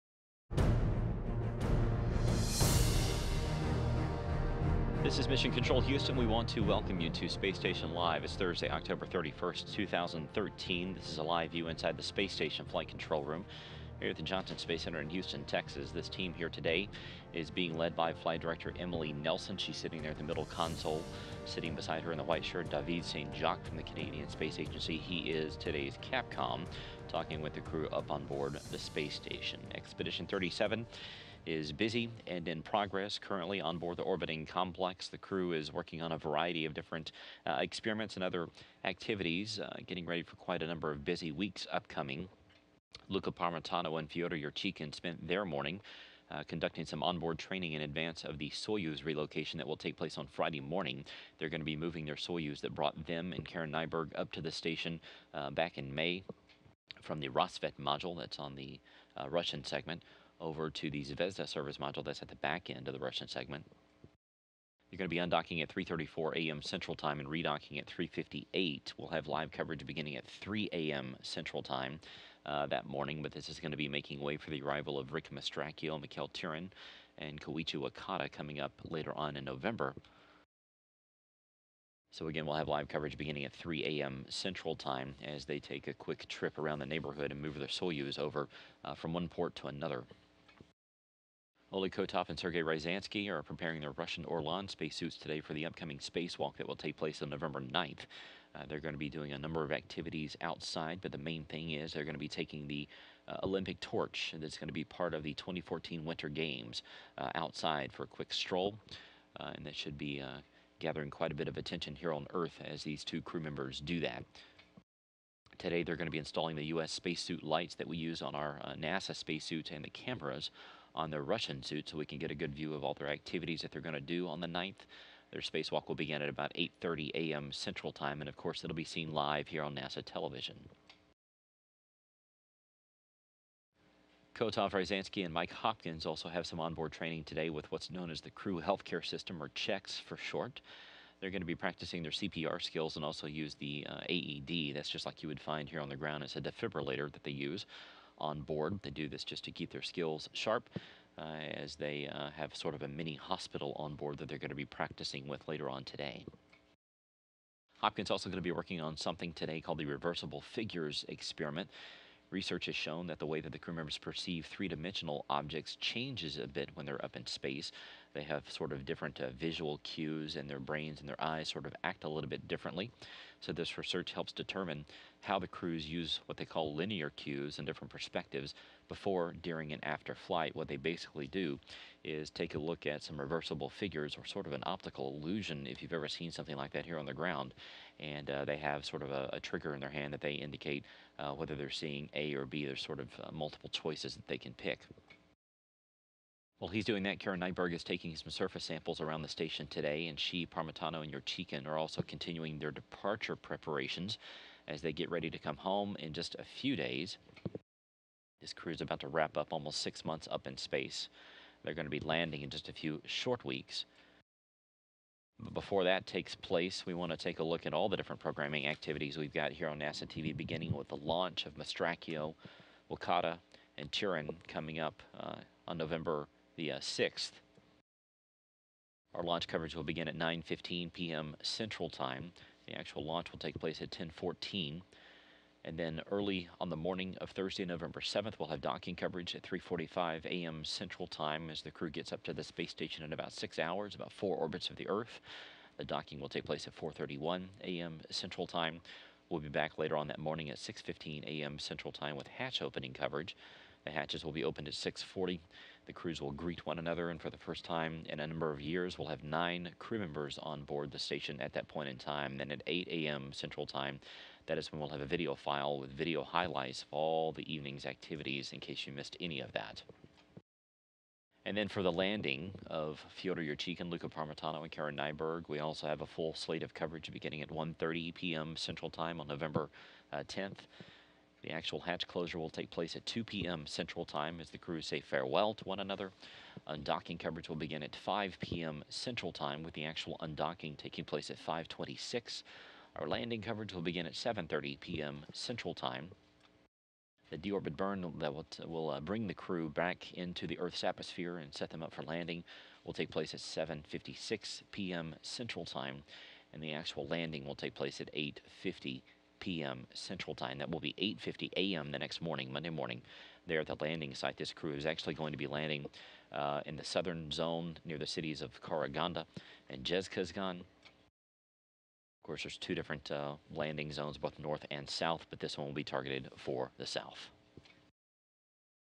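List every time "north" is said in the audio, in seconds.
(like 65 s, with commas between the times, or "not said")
324 s.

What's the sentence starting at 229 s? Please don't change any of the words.
Our launch coverage will begin at 9.15 p.m.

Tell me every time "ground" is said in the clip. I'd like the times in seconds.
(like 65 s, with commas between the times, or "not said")
145 s, 187 s.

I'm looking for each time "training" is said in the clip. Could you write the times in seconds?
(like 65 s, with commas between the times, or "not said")
47 s, 136 s.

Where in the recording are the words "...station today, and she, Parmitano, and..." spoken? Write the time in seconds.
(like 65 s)
199 s.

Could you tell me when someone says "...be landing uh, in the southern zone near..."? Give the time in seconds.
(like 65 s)
315 s.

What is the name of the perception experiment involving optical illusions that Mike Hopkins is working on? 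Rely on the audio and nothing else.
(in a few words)
reversible figures experiment.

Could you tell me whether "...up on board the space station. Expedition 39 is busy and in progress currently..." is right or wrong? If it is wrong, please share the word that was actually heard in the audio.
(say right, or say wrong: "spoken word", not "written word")
wrong: "37", not "39".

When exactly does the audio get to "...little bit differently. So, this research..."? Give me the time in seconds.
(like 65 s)
172 s.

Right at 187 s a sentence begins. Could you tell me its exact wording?
And uh, they have sort of a, a, trigger in their hand that they indicate uh, whether they're seeing A or B.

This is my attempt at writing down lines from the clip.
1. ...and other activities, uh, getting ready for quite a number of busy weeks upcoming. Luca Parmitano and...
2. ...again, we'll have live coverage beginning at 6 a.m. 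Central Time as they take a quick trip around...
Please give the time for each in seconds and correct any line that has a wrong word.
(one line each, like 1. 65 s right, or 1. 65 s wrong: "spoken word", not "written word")
1. 38 s right
2. 82 s wrong: "3", not "6".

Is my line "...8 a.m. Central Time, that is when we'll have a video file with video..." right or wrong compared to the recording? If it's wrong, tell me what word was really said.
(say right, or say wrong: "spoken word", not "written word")
right.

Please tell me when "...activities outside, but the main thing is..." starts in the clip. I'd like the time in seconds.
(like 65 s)
99 s.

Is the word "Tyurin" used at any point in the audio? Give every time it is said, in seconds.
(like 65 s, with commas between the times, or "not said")
76 s, 223 s.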